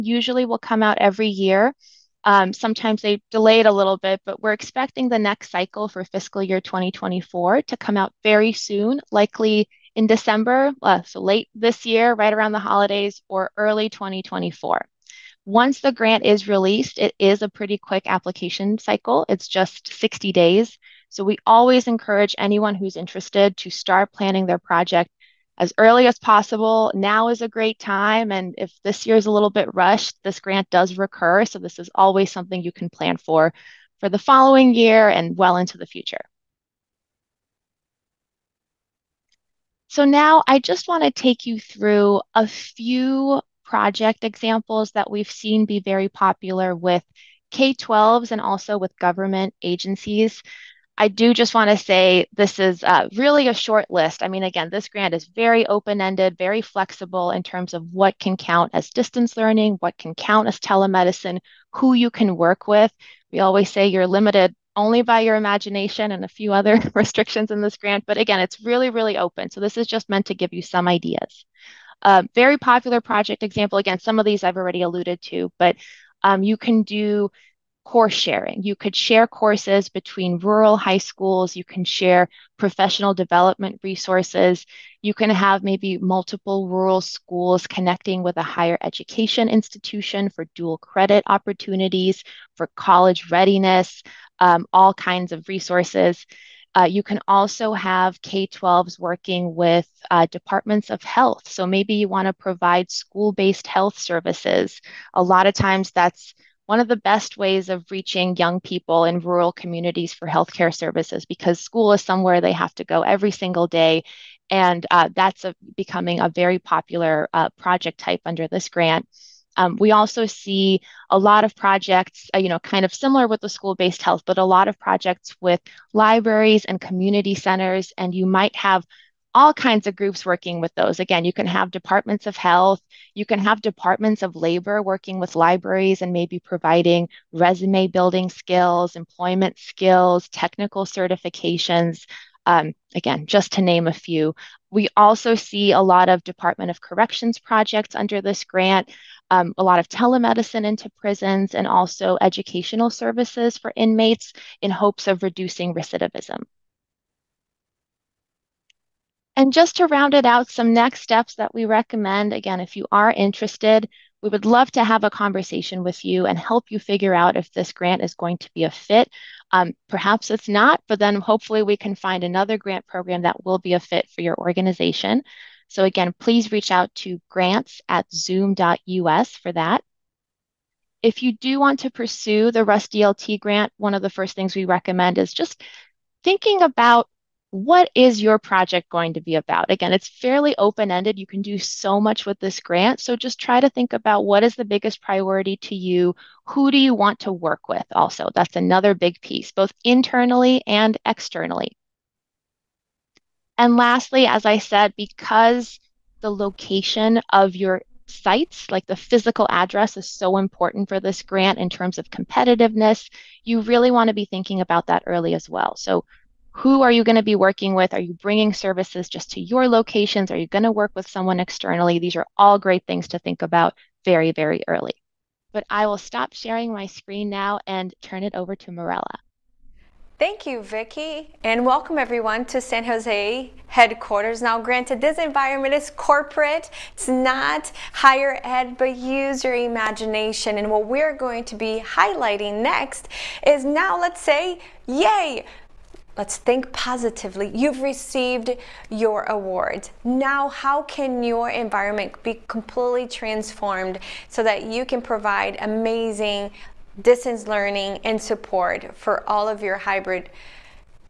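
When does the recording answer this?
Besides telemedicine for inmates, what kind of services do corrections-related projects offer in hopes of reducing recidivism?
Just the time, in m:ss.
2:32.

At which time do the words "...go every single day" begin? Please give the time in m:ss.
1:52.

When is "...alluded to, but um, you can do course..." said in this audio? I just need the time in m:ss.
1:14.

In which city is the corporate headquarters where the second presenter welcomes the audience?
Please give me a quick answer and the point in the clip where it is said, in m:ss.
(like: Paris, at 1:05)
San Jose, at 3:52.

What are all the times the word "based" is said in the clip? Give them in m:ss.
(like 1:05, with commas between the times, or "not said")
1:43, 2:03.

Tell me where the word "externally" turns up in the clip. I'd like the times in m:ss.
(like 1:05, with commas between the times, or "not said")
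3:21, 3:41.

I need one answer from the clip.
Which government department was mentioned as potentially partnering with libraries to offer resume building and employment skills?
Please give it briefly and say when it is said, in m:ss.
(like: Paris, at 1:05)
Departments of labor, at 2:13.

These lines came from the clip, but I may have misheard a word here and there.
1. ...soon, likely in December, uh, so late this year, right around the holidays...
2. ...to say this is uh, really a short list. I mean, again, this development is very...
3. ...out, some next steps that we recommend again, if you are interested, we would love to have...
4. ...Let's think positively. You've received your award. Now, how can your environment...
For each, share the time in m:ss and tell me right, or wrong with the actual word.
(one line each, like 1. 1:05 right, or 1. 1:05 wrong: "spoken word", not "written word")
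1. 0:08 right
2. 0:51 wrong: "grant", not "development"
3. 2:40 right
4. 4:06 right.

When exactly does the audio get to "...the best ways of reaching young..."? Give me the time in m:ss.
1:46.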